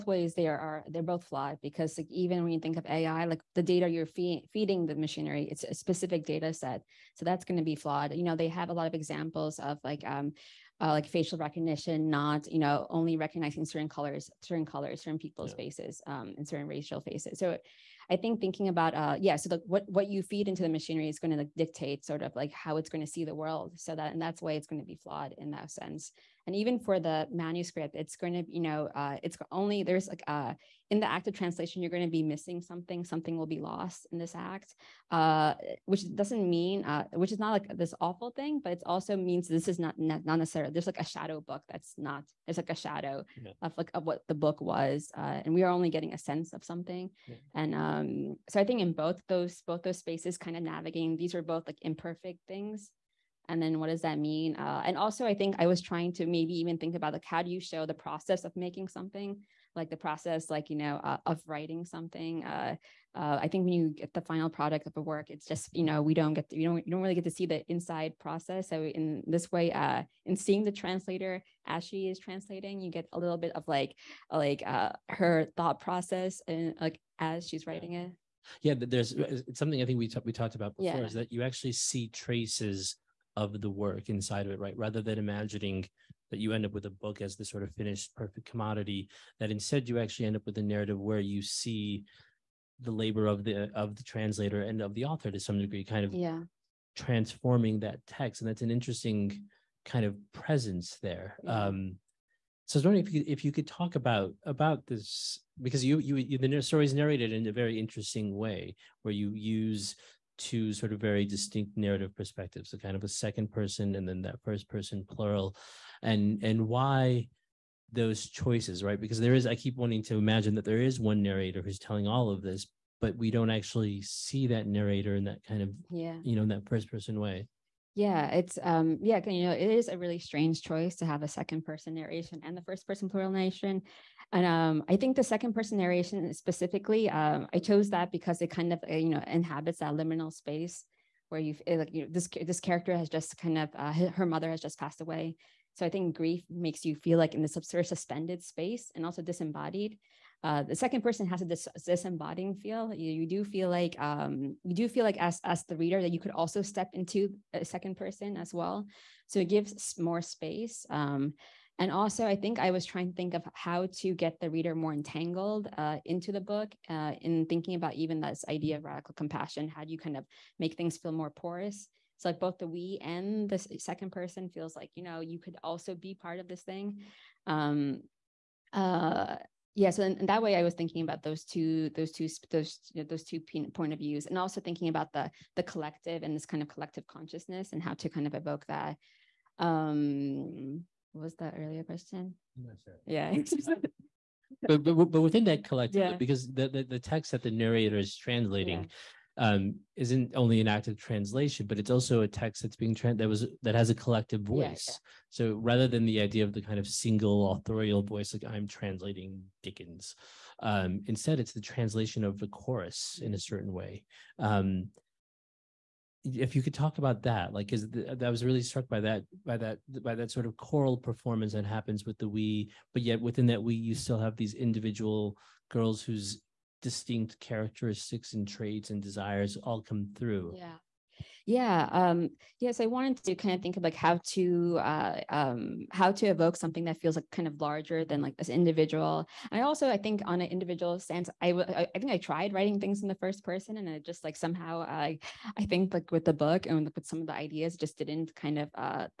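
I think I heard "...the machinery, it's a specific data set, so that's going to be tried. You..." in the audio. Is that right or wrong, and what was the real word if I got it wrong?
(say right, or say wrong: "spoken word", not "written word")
wrong: "flawed", not "tried".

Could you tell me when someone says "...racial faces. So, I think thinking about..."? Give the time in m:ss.
0:16.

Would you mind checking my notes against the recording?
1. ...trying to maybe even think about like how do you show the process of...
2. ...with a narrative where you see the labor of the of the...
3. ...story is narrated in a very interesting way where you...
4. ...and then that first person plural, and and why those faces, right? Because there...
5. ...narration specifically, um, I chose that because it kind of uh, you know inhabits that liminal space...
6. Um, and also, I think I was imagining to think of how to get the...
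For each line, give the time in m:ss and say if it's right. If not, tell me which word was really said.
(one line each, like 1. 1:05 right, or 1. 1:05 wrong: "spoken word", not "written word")
1. 0:55 right
2. 1:30 right
3. 1:46 right
4. 1:53 wrong: "choices", not "faces"
5. 2:15 right
6. 2:40 wrong: "trying", not "imagining".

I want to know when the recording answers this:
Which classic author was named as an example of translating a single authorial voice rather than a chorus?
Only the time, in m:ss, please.
3:29.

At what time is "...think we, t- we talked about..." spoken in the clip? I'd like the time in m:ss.
1:19.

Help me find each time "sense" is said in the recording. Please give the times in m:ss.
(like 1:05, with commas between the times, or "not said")
0:25, 0:46, 4:00.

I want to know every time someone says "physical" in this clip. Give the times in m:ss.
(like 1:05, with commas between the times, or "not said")
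not said.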